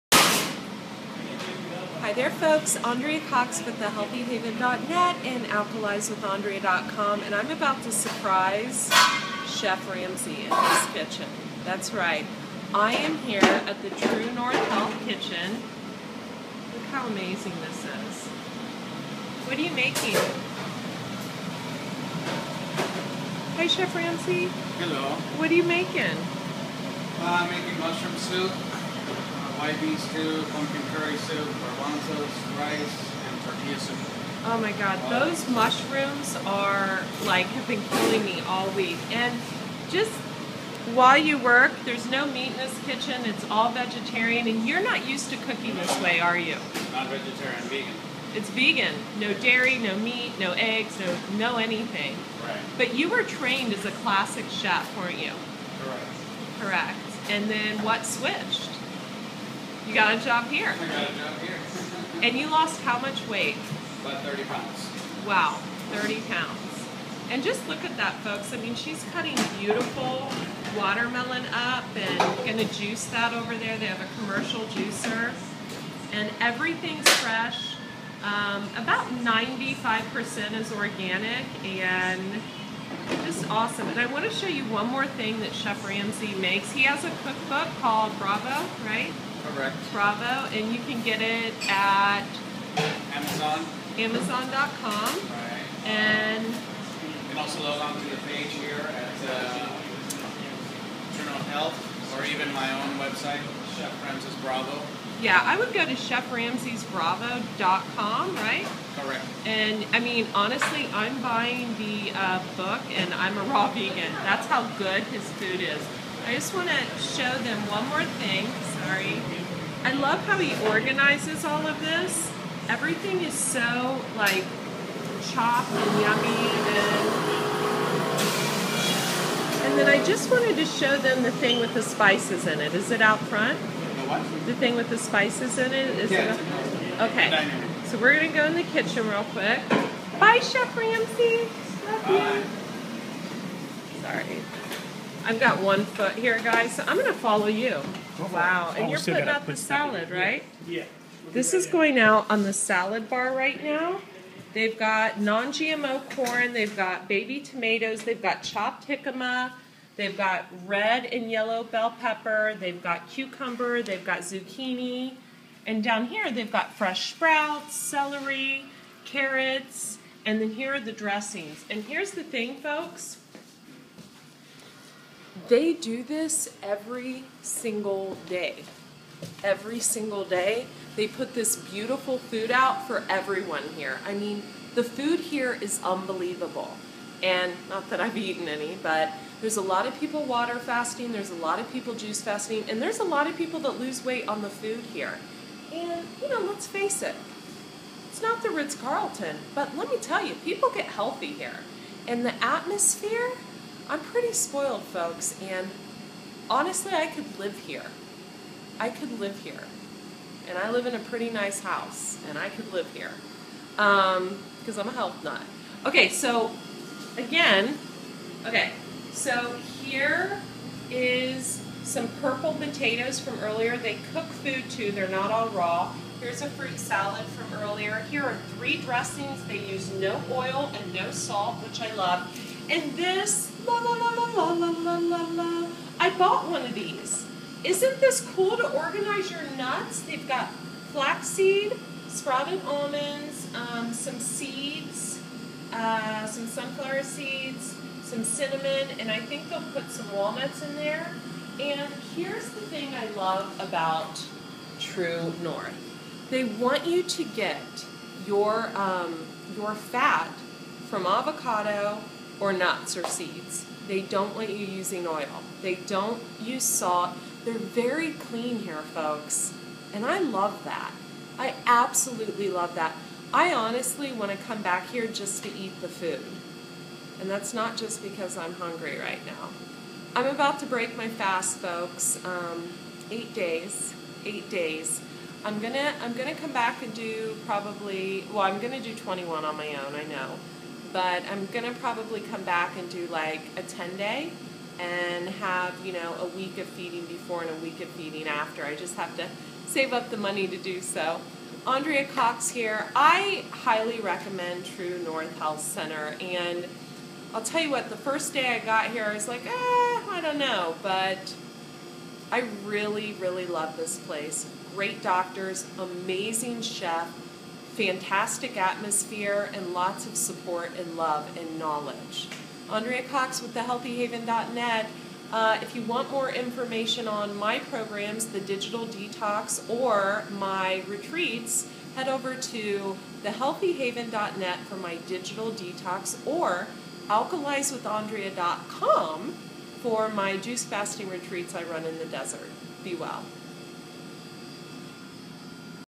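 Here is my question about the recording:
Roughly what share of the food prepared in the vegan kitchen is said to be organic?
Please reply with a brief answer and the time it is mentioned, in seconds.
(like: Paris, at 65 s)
95%, at 79 s.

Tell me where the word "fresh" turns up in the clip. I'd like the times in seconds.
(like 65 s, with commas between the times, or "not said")
77 s, 166 s.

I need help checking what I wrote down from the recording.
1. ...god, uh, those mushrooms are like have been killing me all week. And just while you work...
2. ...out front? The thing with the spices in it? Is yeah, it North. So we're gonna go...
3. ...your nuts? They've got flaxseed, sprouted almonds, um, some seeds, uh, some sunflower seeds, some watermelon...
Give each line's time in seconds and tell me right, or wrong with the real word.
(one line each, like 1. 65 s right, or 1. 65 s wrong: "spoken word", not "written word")
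1. 34 s right
2. 133 s wrong: "Okay", not "North"
3. 239 s wrong: "cinnamon", not "watermelon".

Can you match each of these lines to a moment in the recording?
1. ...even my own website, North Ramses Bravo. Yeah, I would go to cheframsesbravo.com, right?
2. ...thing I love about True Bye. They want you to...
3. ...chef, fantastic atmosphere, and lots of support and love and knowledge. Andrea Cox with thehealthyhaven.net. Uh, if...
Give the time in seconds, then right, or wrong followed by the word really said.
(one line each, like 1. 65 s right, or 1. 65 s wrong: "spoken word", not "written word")
1. 102 s wrong: "Chef", not "North"
2. 252 s wrong: "North", not "Bye"
3. 316 s right.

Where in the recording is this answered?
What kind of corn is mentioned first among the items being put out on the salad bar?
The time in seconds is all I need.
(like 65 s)
155 s.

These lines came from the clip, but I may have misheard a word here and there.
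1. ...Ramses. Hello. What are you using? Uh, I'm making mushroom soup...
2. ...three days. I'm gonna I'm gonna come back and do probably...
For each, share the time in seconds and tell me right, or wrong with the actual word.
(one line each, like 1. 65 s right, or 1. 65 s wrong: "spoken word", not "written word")
1. 23 s wrong: "making", not "using"
2. 284 s wrong: "eight", not "three".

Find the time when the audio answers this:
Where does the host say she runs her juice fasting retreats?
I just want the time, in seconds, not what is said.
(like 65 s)
341 s.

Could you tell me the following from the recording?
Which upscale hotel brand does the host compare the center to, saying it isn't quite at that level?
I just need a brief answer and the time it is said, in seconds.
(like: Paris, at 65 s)
Ritz Carlton, at 198 s.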